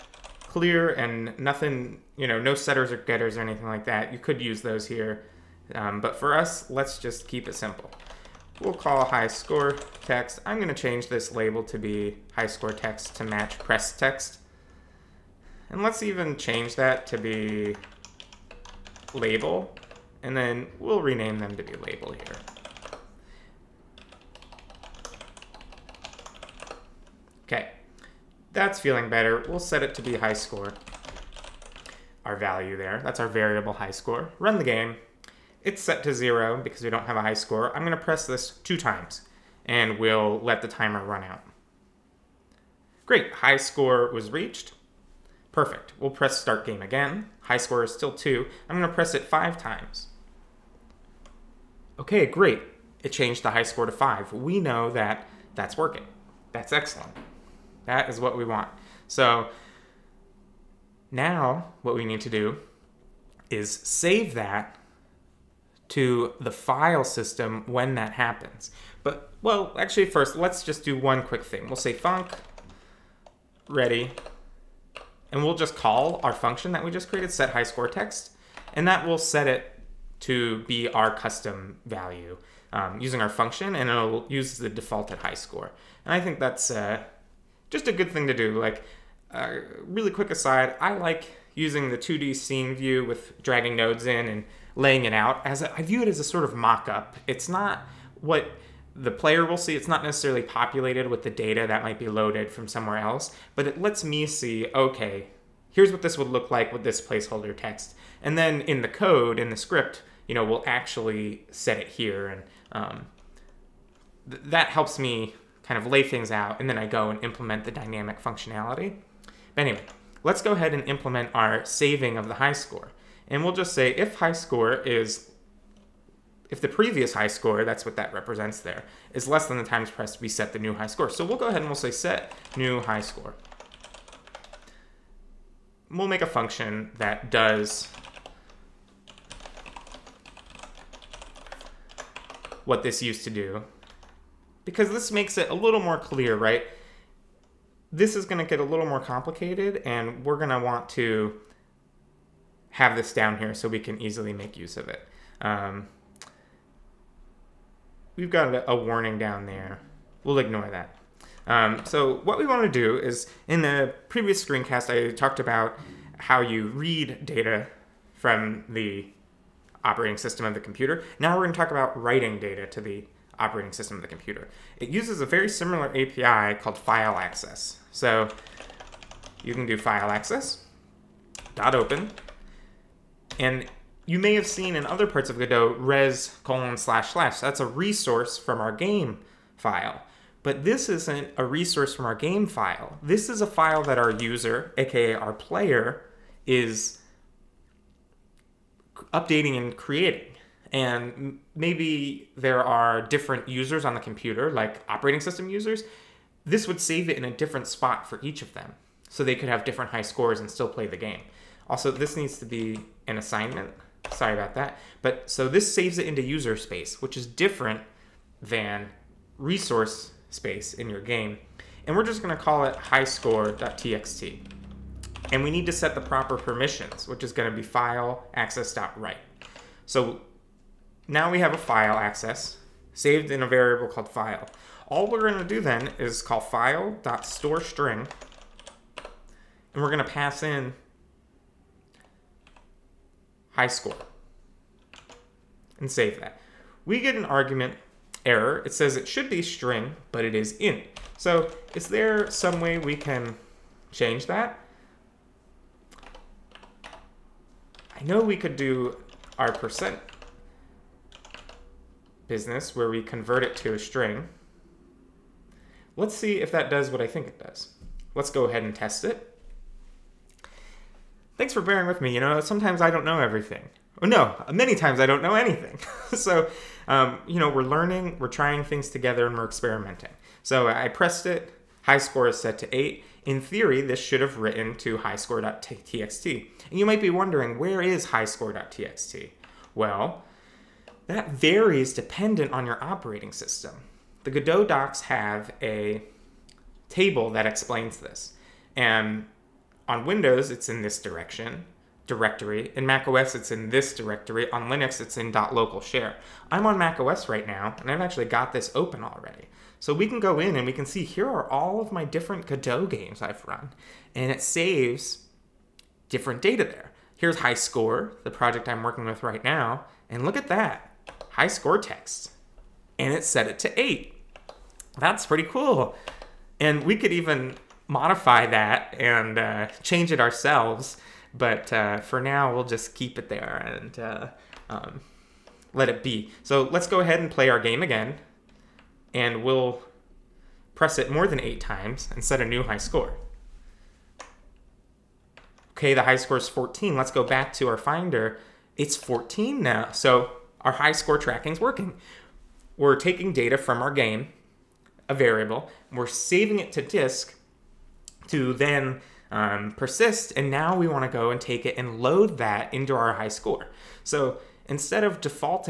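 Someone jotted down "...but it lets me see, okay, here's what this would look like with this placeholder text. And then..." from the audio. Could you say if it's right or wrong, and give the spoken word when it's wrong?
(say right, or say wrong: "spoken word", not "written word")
right.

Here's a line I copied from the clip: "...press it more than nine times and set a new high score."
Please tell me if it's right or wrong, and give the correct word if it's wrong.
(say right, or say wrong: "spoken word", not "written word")
wrong: "eight", not "nine".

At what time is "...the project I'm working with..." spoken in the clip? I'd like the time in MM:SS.
05:18.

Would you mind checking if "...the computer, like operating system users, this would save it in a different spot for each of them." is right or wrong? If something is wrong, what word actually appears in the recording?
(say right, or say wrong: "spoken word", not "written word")
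right.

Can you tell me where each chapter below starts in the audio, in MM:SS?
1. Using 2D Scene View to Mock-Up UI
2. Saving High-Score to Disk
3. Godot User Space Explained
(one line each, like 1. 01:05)
1. 01:31
2. 01:59
3. 04:46.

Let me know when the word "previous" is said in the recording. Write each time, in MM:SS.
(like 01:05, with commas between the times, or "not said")
02:06, 02:44.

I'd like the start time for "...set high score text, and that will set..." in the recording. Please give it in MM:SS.
01:17.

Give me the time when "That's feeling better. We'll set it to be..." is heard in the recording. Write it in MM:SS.
00:28.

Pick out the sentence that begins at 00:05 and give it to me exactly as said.
Um, but for us, let's just keep it simple.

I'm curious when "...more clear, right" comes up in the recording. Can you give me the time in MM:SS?
02:25.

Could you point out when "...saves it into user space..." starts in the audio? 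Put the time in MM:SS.
03:35.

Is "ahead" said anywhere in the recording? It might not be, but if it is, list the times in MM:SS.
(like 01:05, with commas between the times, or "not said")
02:00, 02:11, 04:28, 05:36.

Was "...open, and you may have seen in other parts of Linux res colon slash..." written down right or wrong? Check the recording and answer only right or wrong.
wrong.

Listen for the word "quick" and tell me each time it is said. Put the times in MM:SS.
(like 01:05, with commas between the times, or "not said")
01:11, 01:30.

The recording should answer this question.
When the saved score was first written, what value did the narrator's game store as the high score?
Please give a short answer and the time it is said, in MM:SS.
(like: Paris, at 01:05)
8, at 04:42.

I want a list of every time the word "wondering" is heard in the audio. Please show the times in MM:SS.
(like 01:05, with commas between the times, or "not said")
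04:47.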